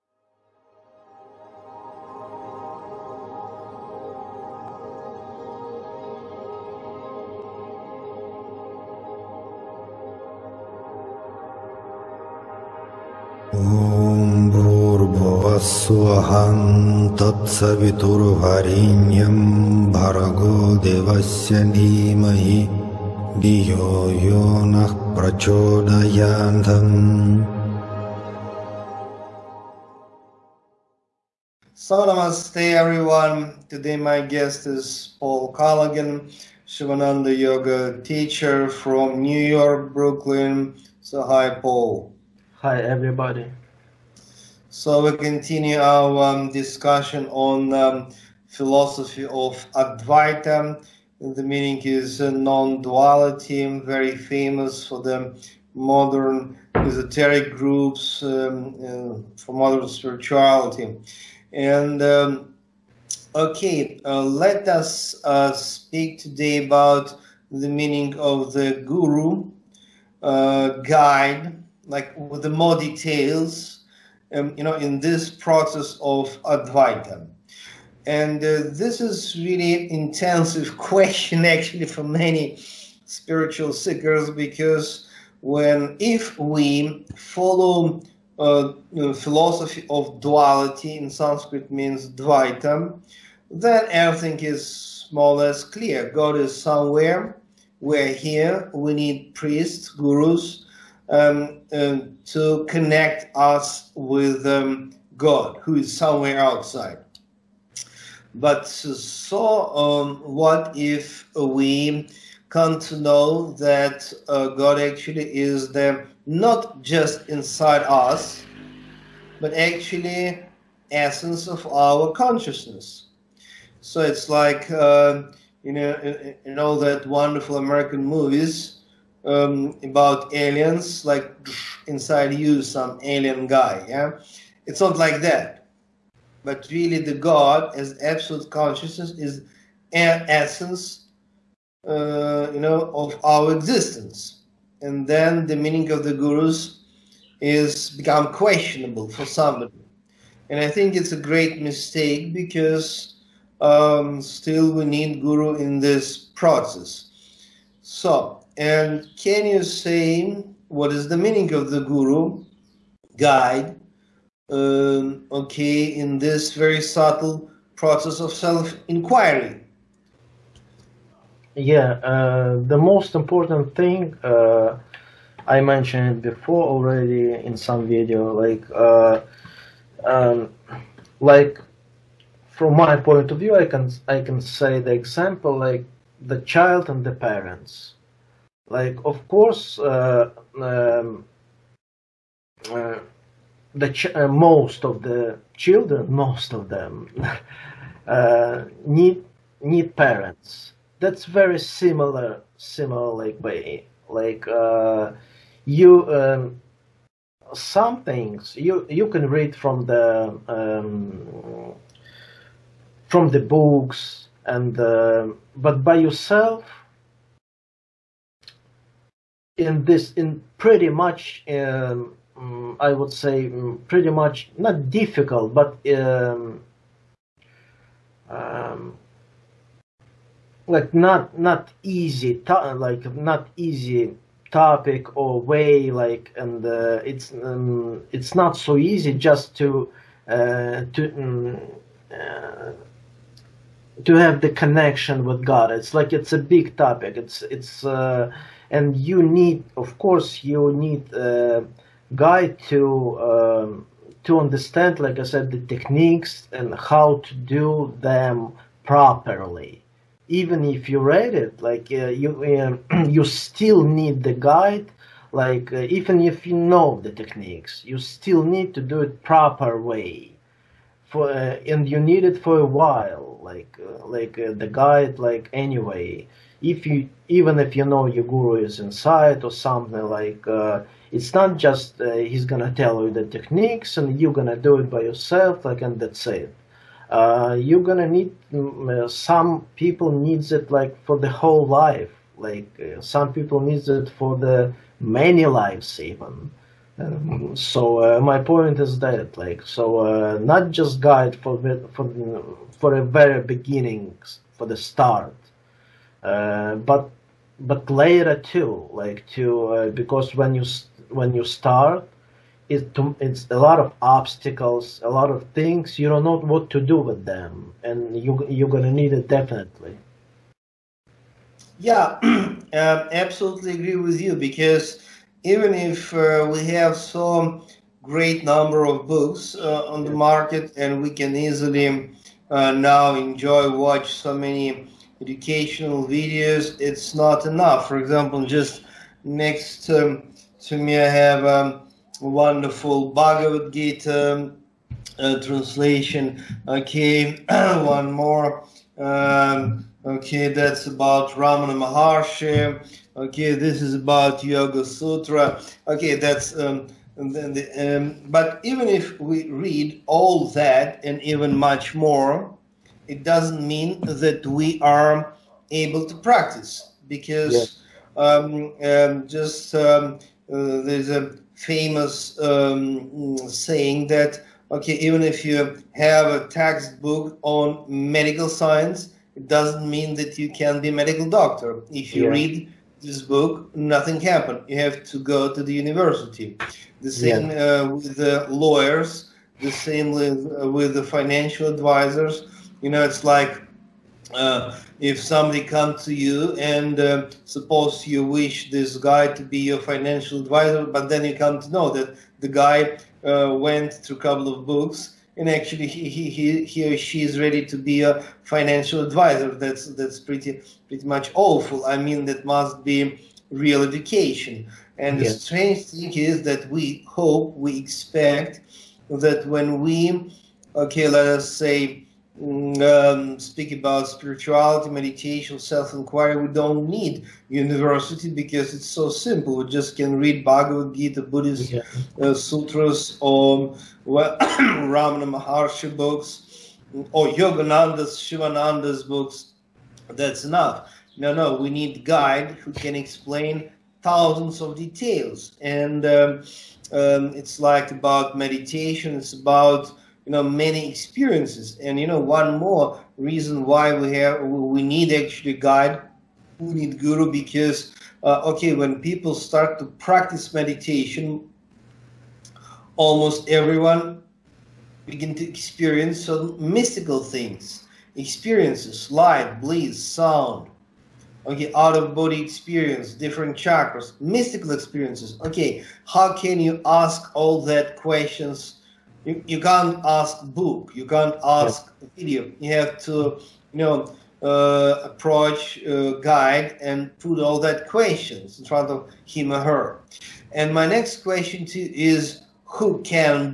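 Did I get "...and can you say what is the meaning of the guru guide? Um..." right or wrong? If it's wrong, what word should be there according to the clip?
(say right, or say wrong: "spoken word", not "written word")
right.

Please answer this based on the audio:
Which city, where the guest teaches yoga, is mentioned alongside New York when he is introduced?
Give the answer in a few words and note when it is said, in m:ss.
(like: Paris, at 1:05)
Brooklyn, at 0:39.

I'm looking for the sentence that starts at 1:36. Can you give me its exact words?
God is somewhere, we're here, we need priests, gurus, um, um, to connect us with um, God, who is somewhere outside.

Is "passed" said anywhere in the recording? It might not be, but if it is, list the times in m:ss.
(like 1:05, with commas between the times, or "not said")
not said.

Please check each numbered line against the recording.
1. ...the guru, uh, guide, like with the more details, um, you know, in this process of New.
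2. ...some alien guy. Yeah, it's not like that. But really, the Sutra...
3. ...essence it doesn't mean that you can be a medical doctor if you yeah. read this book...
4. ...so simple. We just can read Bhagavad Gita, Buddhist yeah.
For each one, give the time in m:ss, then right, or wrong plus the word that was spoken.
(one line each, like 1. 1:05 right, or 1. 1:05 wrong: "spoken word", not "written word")
1. 1:08 wrong: "Advaita", not "New"
2. 2:12 wrong: "God", not "Sutra"
3. 6:18 wrong: "science", not "essence"
4. 7:08 right.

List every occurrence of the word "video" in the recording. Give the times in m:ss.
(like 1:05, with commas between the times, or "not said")
2:57, 5:36, 8:02.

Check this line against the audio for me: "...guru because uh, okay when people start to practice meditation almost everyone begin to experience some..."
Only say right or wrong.
right.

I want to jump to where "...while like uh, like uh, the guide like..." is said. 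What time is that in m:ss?
4:32.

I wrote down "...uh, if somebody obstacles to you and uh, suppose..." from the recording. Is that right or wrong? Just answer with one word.
wrong.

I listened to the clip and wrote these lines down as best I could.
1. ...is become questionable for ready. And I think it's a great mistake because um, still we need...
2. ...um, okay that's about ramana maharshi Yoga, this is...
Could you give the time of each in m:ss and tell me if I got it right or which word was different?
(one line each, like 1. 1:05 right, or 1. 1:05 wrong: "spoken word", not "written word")
1. 2:27 wrong: "somebody", not "ready"
2. 5:48 wrong: "Okay", not "Yoga".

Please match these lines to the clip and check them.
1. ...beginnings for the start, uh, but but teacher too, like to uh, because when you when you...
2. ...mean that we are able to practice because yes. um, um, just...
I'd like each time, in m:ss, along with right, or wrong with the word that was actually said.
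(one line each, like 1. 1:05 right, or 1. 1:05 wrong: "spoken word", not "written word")
1. 5:03 wrong: "later", not "teacher"
2. 6:03 right.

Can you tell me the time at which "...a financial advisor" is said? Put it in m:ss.
6:48.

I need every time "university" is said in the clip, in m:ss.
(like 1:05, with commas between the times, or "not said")
6:25, 7:07.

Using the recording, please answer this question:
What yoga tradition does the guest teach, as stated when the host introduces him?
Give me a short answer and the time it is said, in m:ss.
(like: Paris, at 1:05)
Sivananda Yoga, at 0:36.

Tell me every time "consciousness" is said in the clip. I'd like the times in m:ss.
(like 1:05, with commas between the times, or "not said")
2:02, 2:18.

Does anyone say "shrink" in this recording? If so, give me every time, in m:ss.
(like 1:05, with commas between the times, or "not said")
not said.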